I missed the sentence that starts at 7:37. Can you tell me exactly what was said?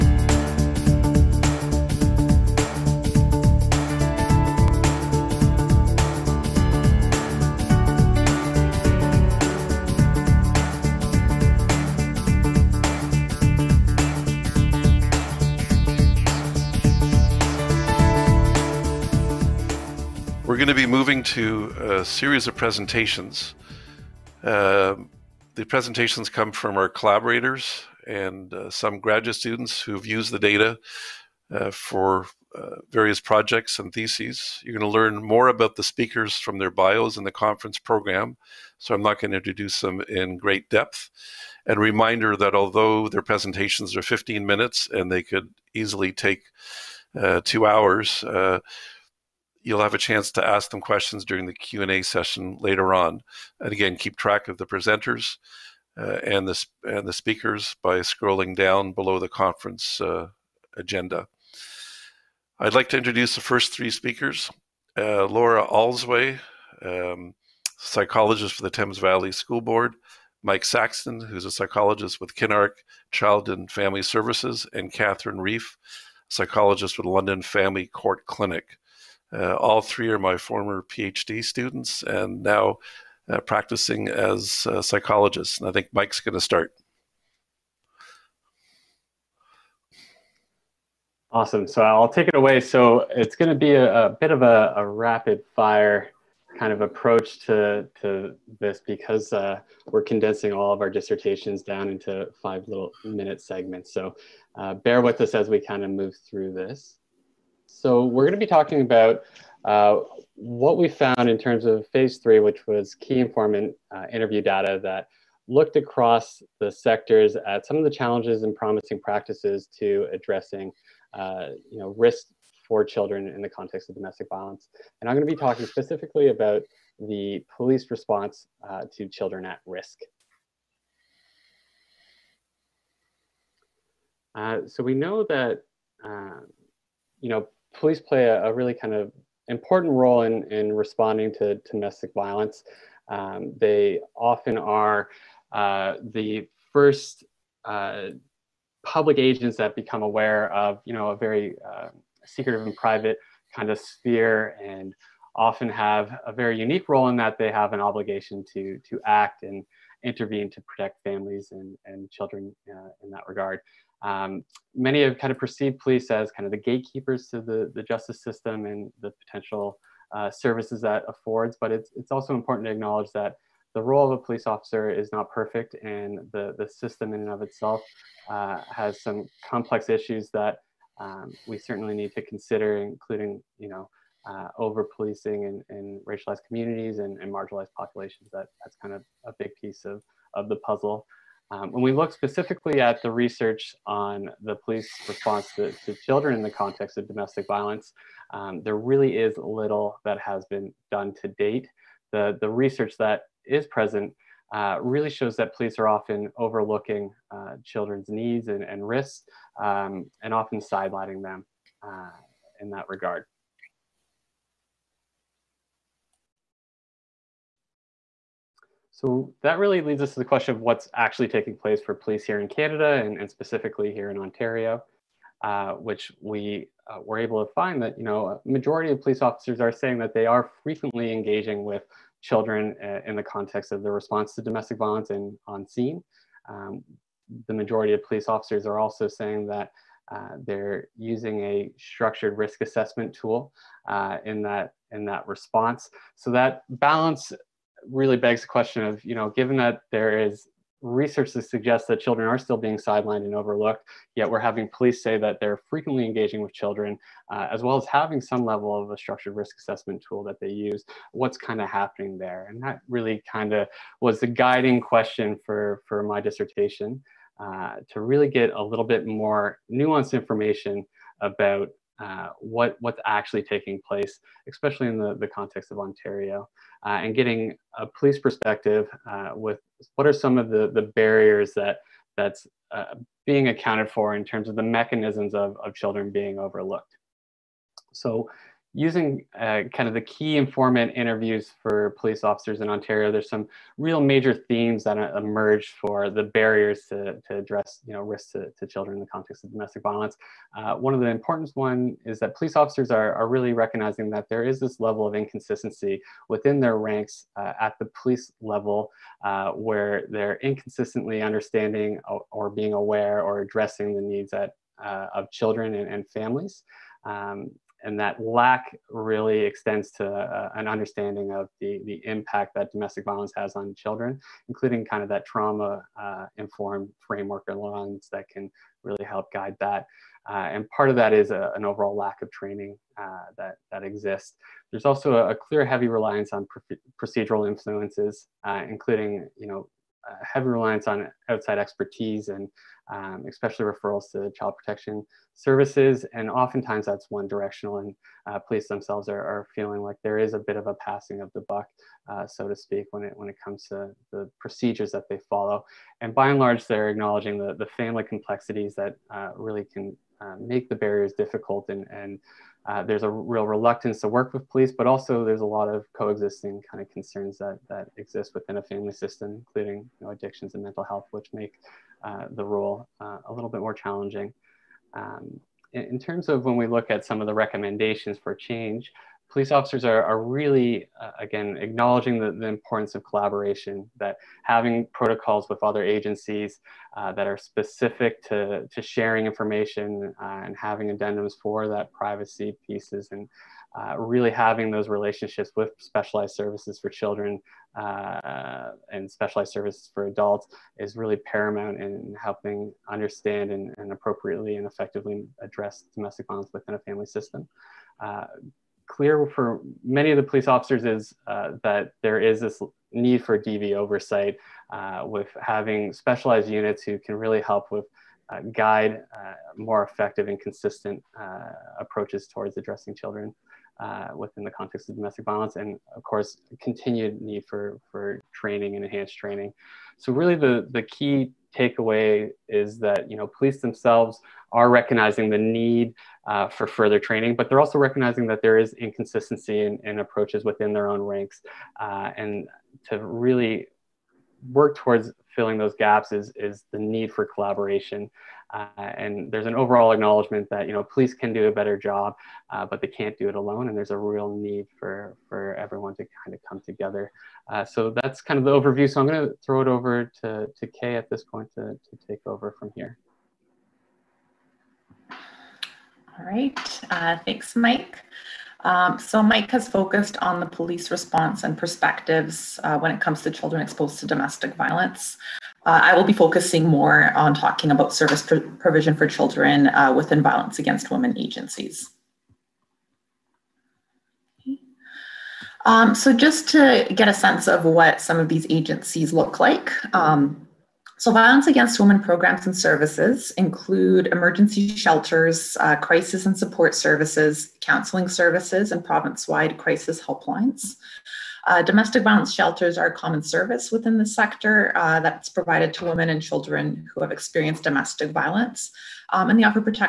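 Uh, so that's kind of the overview.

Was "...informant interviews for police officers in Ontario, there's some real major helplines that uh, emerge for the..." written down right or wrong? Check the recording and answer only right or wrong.
wrong.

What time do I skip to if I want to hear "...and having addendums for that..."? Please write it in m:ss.
6:30.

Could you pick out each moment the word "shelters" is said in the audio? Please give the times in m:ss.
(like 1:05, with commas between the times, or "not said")
8:14, 8:22.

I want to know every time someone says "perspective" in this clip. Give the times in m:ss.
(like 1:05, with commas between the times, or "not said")
4:38, 7:51.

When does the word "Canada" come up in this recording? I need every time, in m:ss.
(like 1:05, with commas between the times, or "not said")
3:42.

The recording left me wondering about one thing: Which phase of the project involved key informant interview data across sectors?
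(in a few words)
Phase 3.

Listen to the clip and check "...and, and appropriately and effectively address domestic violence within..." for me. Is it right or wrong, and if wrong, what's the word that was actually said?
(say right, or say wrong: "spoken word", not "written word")
right.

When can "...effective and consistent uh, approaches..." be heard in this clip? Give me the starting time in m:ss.
6:59.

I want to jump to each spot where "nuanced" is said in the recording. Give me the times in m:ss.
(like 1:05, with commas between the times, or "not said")
4:29.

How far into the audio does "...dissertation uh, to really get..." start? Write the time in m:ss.
4:26.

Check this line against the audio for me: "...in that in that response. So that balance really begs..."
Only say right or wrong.
right.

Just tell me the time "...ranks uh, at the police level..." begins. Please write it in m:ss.
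5:06.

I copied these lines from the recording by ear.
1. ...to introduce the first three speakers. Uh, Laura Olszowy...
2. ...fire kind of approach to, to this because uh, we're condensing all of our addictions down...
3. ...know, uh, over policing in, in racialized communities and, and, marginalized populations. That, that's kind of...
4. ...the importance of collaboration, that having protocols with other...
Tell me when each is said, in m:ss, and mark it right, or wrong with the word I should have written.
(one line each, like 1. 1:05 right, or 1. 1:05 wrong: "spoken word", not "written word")
1. 1:02 right
2. 1:35 wrong: "dissertations", not "addictions"
3. 3:03 right
4. 6:22 right.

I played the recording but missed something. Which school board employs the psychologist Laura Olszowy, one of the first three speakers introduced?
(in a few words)
Thames Valley School Board.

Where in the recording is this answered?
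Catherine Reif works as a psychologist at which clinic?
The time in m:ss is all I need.
1:17.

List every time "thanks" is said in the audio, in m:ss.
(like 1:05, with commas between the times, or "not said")
7:47.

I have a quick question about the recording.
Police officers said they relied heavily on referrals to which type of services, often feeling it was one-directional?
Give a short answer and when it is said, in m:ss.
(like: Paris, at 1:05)
Child protection services, at 5:44.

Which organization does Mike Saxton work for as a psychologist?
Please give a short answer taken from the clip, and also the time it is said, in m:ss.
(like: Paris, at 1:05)
Kinark Child and Family Services, at 1:12.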